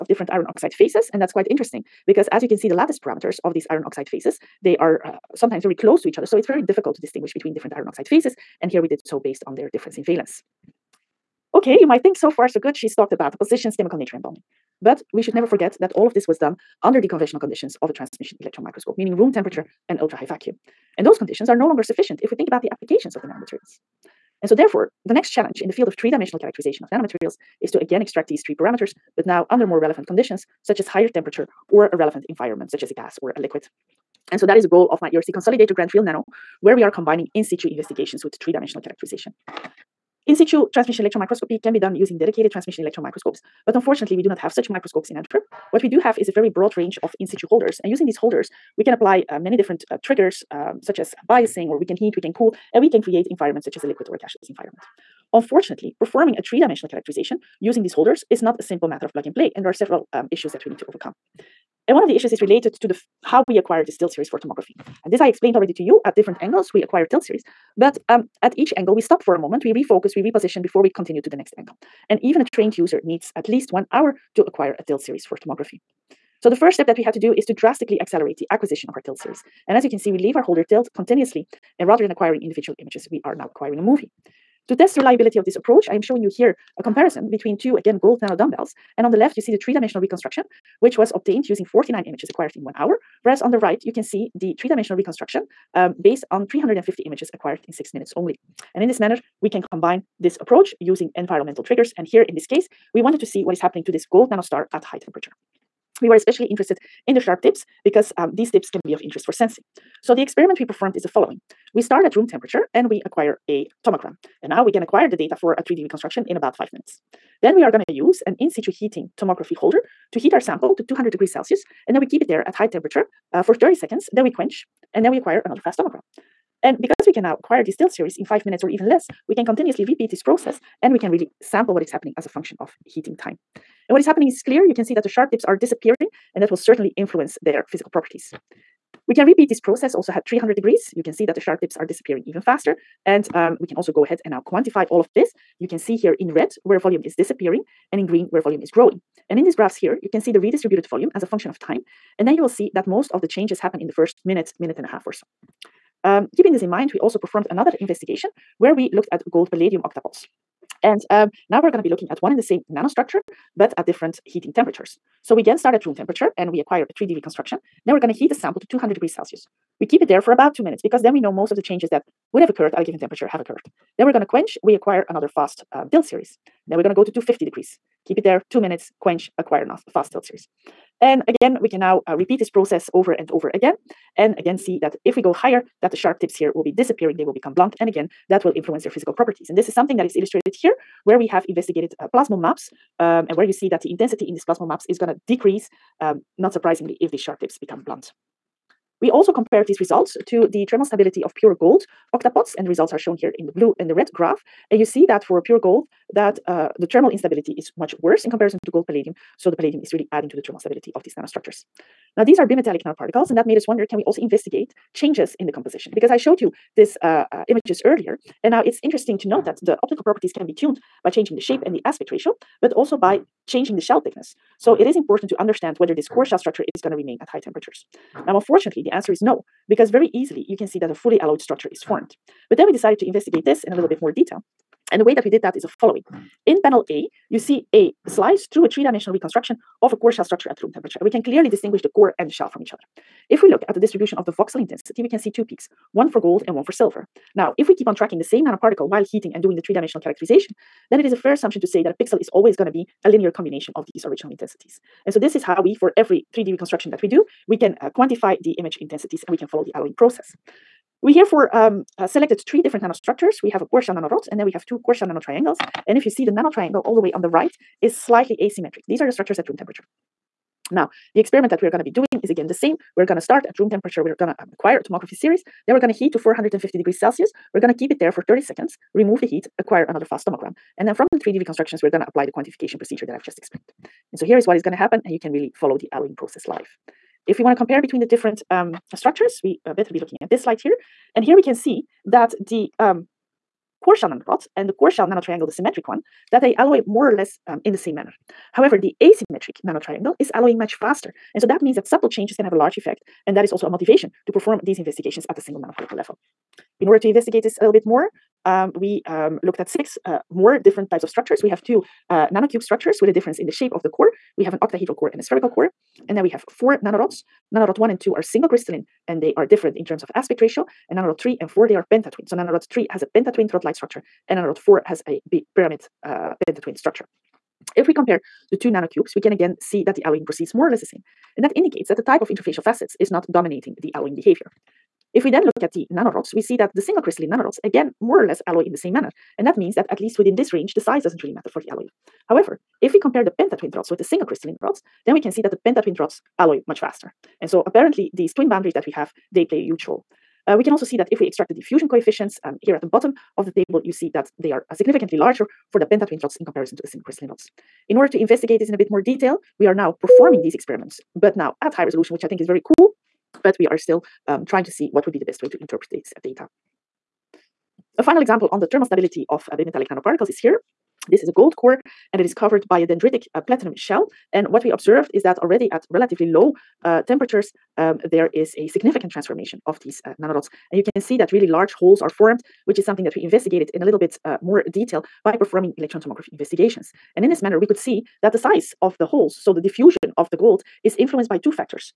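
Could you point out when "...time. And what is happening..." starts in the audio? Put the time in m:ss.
2:13.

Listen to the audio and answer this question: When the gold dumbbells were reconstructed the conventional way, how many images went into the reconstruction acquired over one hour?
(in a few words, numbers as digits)
49.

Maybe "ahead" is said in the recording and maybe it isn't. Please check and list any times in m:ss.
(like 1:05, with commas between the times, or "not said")
2:24.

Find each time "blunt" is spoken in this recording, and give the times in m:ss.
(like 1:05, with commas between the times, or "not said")
3:07, 3:17.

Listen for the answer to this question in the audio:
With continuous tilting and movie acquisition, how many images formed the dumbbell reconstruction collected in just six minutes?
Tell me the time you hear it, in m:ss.
1:36.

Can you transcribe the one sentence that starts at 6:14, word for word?
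And what we observed is that already at relatively low uh, temperatures, um, there is a significant transformation of these uh, nanorods.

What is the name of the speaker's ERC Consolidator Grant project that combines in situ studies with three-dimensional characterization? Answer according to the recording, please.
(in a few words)
Field Nano.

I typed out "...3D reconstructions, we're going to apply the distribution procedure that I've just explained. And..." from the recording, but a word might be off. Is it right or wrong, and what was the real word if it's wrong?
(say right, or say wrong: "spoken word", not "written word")
wrong: "quantification", not "distribution".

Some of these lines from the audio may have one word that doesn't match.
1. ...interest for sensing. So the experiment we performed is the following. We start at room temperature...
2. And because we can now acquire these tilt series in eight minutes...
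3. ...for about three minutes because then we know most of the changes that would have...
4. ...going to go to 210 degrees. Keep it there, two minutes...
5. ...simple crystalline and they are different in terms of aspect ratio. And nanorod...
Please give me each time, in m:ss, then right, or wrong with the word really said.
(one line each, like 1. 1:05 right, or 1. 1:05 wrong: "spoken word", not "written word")
1. 1:49 right
2. 2:06 wrong: "five", not "eight"
3. 2:50 wrong: "two", not "three"
4. 2:56 wrong: "250", not "210"
5. 5:18 wrong: "single", not "simple".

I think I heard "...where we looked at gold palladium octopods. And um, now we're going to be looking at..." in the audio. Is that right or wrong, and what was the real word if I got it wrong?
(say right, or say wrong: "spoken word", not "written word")
right.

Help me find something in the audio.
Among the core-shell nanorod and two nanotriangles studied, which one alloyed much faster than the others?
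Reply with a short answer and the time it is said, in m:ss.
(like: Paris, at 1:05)
The asymmetric nanotriangle, at 4:59.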